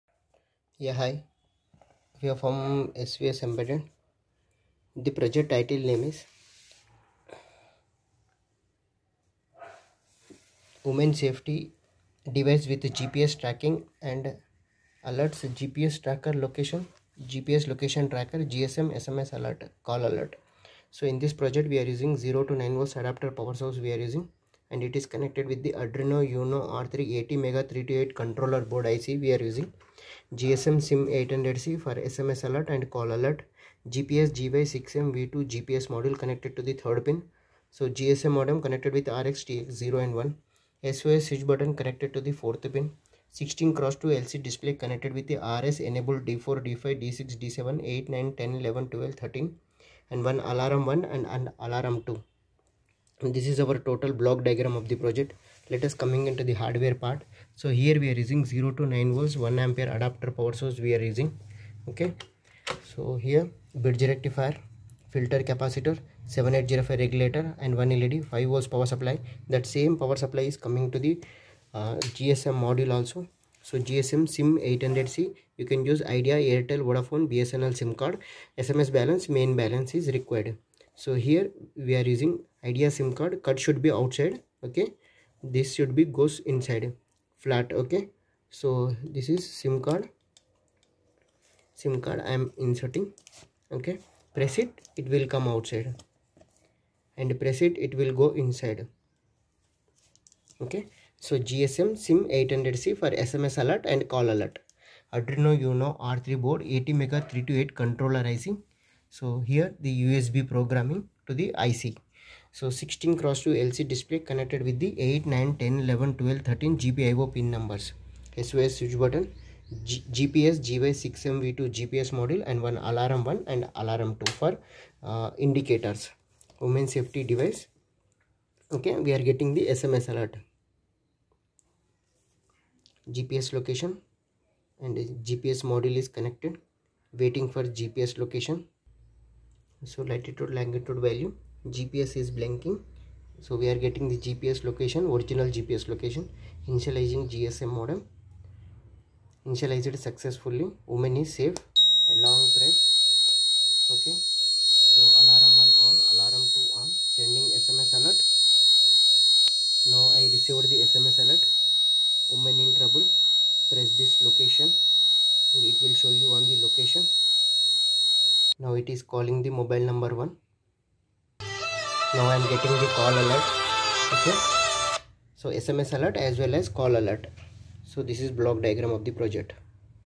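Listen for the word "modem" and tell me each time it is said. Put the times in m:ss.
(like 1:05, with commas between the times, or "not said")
0:38, 2:27.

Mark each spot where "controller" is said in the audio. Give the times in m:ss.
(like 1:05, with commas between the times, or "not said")
0:28, 1:47.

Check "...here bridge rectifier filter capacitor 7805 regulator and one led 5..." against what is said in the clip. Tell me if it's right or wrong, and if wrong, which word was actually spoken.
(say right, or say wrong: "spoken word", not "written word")
right.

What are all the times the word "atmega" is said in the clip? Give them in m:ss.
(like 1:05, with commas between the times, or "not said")
0:27, 1:46.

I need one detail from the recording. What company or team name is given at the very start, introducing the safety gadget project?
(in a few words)
SVS Embedded.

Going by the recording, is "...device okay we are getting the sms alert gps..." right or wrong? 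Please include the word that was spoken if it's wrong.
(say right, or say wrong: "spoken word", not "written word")
right.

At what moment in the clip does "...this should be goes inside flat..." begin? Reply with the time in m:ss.
1:25.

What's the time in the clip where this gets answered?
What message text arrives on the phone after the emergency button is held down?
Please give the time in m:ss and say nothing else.
2:42.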